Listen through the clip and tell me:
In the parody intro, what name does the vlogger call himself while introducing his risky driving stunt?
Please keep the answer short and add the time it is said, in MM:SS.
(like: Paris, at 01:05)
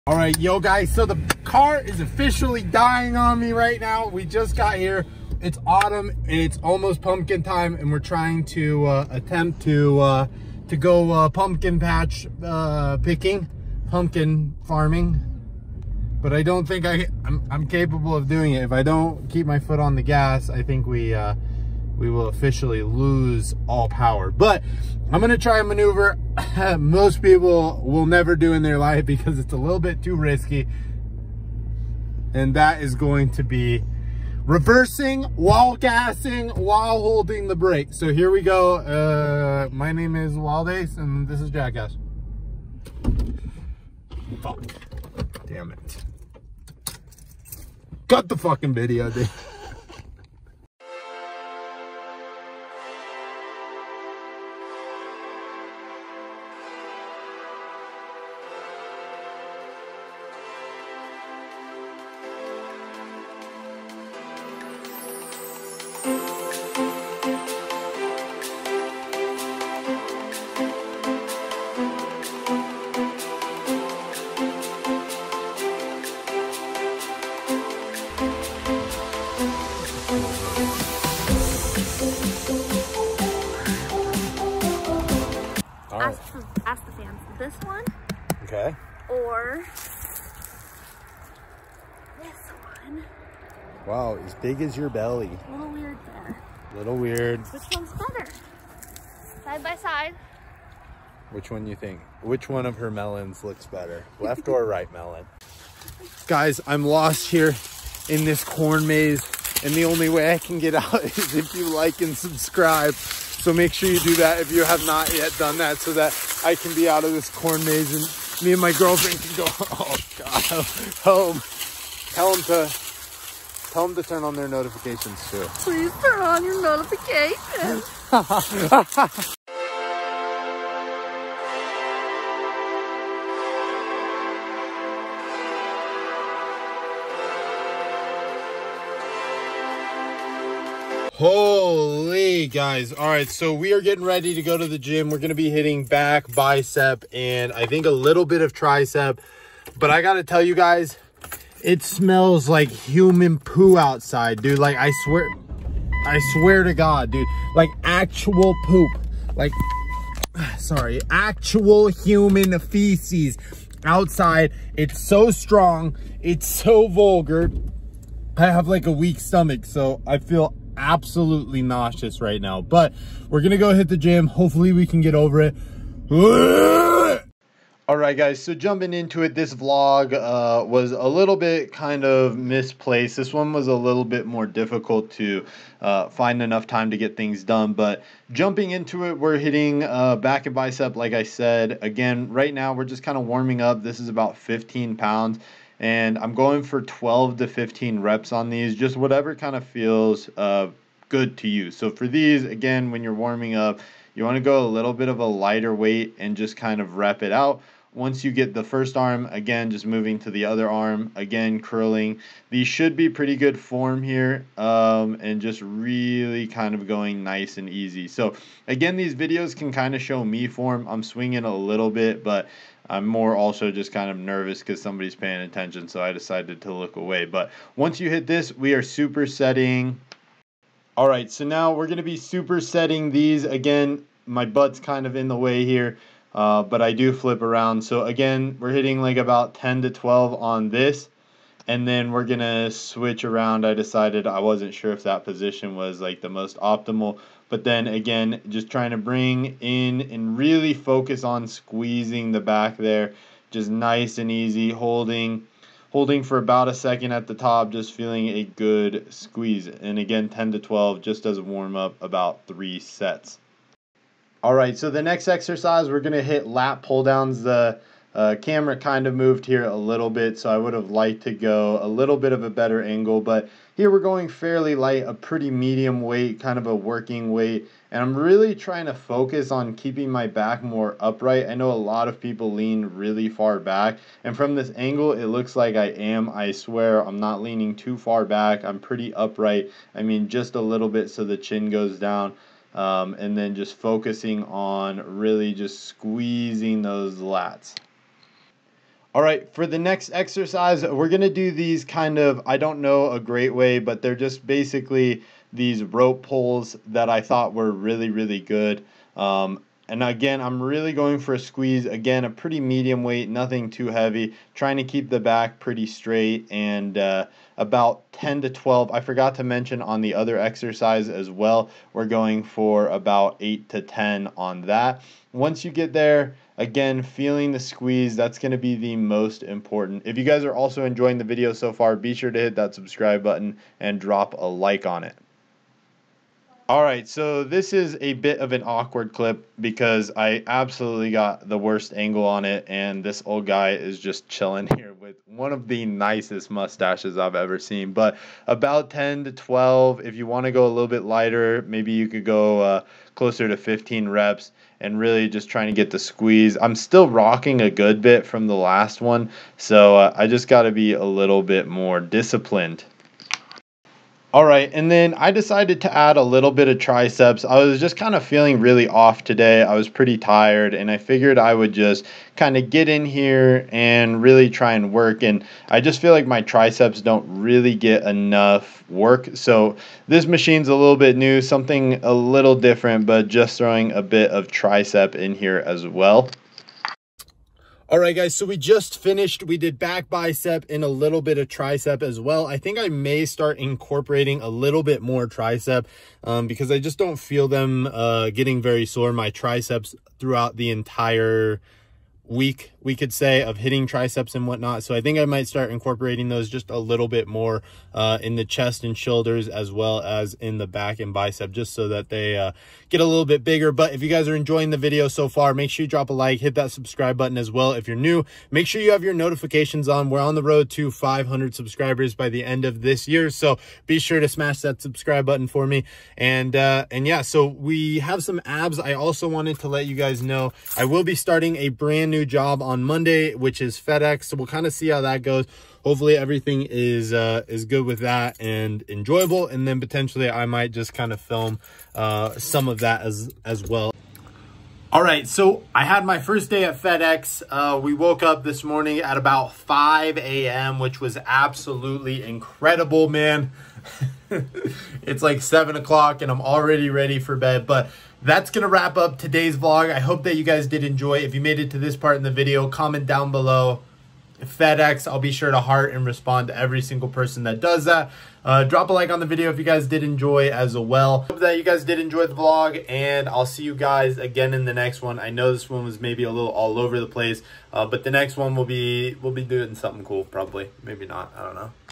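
Waldace, at 00:40.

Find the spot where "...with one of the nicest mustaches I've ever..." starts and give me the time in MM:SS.
05:44.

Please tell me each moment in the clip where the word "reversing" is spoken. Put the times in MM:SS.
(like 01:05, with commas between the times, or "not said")
00:34.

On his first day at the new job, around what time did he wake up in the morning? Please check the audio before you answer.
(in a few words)
5 a.m.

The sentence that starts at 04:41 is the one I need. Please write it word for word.
I know a lot of people lean really far back, and from this angle, it looks like I am.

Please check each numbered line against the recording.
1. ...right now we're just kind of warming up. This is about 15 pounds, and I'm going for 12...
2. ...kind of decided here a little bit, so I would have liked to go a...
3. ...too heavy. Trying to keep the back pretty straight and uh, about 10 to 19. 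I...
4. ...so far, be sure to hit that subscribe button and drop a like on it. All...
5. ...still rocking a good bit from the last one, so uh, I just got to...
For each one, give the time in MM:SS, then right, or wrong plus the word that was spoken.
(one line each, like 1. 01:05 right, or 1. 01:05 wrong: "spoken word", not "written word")
1. 03:12 right
2. 04:28 wrong: "moved", not "decided"
3. 05:13 wrong: "12", not "19"
4. 05:31 right
5. 05:56 right.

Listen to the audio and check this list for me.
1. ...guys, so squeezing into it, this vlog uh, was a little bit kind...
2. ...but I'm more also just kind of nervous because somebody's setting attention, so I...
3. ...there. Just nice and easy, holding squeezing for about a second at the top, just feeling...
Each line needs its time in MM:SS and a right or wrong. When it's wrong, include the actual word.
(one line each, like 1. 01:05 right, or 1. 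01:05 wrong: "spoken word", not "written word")
1. 02:58 wrong: "jumping", not "squeezing"
2. 03:42 wrong: "paying", not "setting"
3. 04:12 wrong: "holding", not "squeezing".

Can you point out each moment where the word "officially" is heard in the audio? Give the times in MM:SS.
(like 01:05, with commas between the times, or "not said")
00:01, 00:22.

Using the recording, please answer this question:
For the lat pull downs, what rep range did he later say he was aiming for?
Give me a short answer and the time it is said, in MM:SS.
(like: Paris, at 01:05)
8 to 10, at 05:23.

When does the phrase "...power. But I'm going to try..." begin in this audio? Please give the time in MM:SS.
00:23.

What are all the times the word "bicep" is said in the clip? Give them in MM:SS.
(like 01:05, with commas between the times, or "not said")
02:26, 03:10, 06:30, 06:51.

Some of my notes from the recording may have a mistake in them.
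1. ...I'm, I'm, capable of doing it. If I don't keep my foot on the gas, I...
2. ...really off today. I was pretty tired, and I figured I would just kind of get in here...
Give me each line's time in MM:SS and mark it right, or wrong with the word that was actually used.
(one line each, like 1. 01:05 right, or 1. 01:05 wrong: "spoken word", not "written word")
1. 00:17 right
2. 06:08 right.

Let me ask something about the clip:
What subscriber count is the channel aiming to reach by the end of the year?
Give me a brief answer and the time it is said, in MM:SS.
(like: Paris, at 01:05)
500, at 07:00.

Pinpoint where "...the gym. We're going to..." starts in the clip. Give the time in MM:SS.
02:24.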